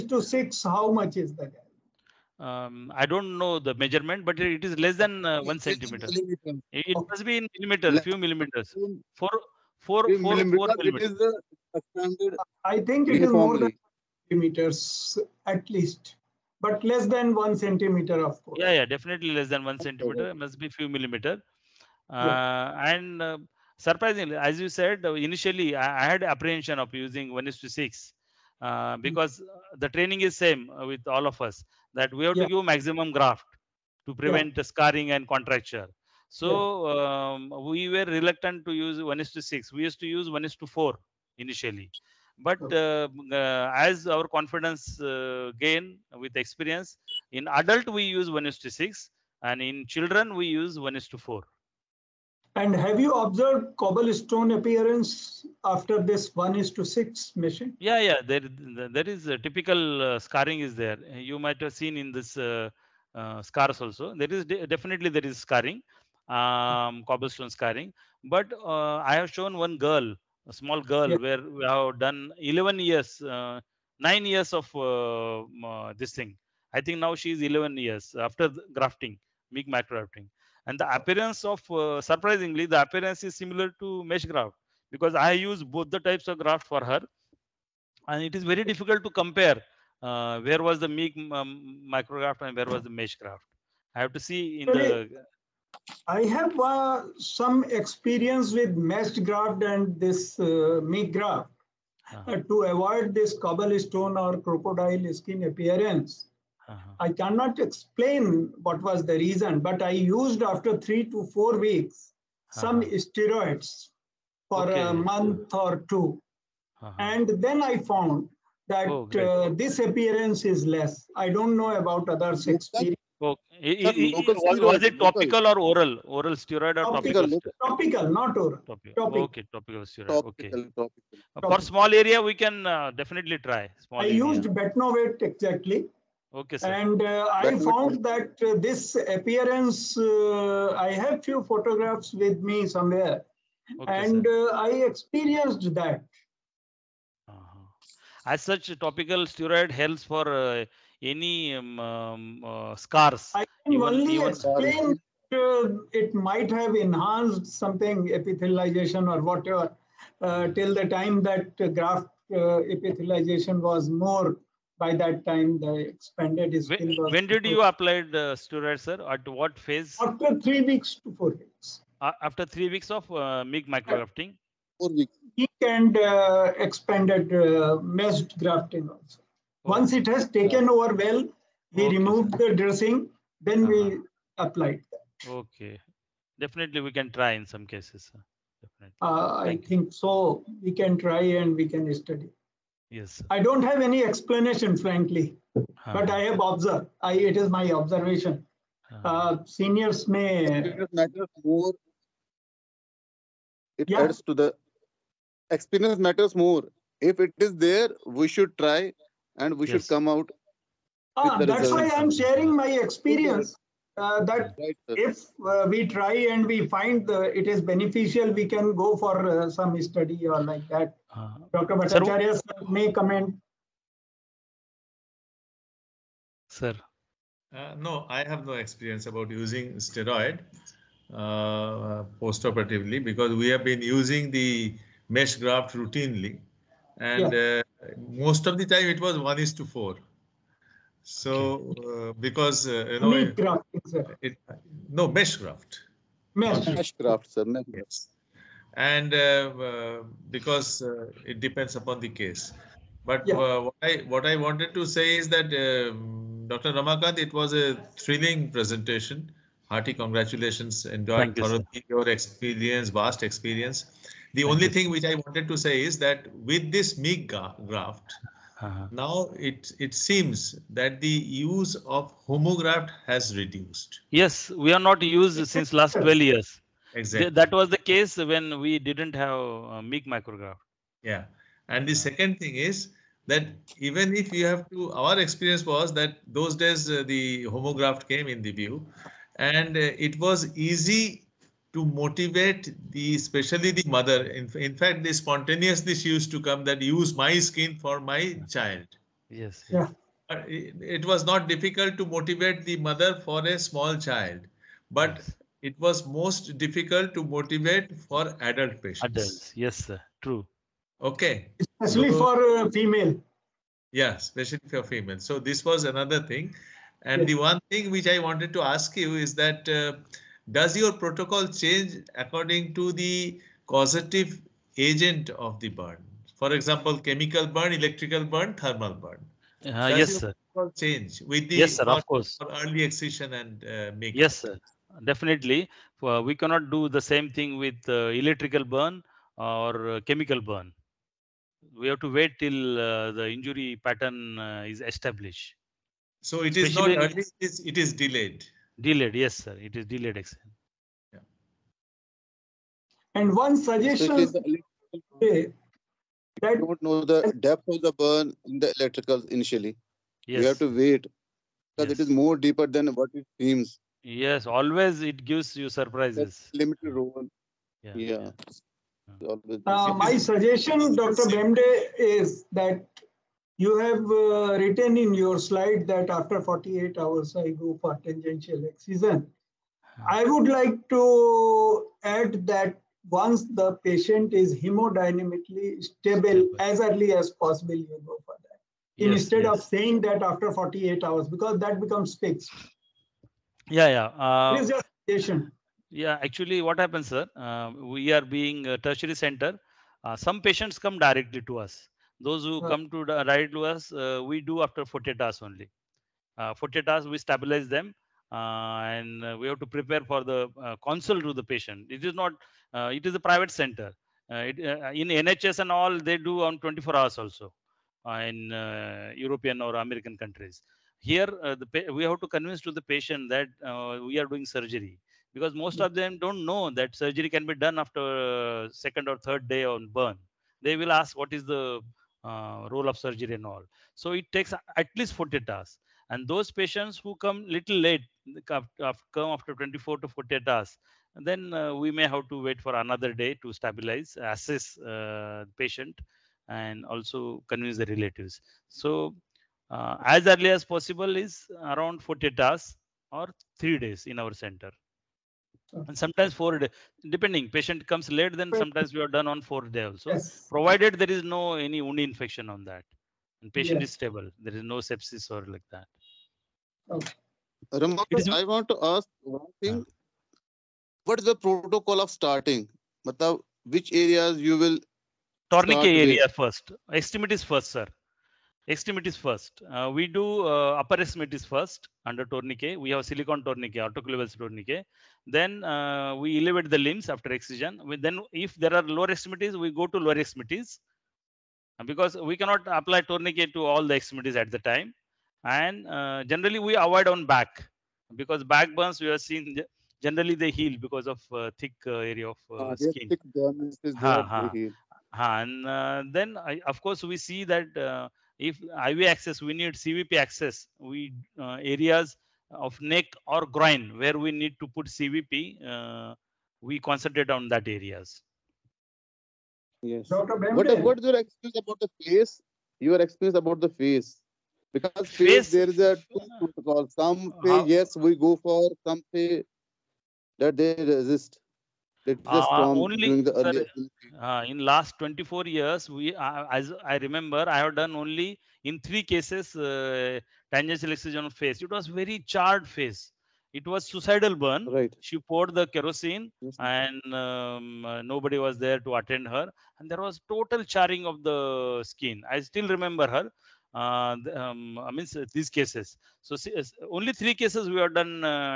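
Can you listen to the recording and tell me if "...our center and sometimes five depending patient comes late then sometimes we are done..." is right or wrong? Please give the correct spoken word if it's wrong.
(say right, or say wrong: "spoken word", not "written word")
wrong: "four", not "five".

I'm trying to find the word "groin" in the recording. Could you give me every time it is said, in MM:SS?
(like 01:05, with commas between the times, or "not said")
08:33.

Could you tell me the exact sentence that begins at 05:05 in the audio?
it was most difficult to motivate for adult patients.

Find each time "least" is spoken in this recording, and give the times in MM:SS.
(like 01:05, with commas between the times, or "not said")
00:15, 07:14.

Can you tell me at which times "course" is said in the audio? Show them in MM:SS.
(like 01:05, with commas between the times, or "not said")
00:18, 05:32, 08:26.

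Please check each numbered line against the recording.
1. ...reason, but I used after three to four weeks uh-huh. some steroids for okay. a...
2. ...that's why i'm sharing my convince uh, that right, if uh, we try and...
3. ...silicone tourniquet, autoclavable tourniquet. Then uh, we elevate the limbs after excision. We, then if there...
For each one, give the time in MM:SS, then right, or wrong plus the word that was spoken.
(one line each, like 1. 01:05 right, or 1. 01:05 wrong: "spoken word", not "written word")
1. 01:49 right
2. 03:31 wrong: "experience", not "convince"
3. 08:03 right.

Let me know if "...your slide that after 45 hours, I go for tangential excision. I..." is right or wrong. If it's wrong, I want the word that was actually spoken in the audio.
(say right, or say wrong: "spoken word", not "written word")
wrong: "48", not "45".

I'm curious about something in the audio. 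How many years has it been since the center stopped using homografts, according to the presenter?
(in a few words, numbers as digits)
12 years.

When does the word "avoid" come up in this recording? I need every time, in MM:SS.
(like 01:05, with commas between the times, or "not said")
01:42, 08:16.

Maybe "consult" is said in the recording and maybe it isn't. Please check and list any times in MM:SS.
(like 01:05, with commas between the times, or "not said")
06:50.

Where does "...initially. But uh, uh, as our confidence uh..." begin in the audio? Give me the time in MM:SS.
00:41.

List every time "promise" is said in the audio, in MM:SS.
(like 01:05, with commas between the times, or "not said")
not said.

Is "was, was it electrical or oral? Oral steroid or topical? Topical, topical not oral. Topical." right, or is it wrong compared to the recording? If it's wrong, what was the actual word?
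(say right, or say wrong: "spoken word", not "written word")
wrong: "topical", not "electrical".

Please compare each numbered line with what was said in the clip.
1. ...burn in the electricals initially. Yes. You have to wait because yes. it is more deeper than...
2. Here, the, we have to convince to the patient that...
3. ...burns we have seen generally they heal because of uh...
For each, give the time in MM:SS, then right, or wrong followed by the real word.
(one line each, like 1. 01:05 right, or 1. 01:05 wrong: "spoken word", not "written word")
1. 05:57 right
2. 07:01 right
3. 08:18 right.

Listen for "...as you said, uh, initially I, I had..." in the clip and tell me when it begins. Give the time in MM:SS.
00:24.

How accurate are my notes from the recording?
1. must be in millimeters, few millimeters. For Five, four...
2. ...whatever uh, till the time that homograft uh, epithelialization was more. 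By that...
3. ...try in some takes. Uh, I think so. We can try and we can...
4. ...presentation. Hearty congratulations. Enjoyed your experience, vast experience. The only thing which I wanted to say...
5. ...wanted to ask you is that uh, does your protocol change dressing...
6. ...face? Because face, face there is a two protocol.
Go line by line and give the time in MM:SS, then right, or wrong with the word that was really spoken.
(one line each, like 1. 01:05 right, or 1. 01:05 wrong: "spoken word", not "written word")
1. 00:07 wrong: "Four", not "Five"
2. 02:39 wrong: "graft", not "homograft"
3. 03:07 wrong: "cases", not "takes"
4. 04:18 right
5. 05:18 wrong: "according", not "dressing"
6. 08:43 right.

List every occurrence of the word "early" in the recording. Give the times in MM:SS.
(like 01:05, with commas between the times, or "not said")
05:32, 05:47, 06:26, 07:30.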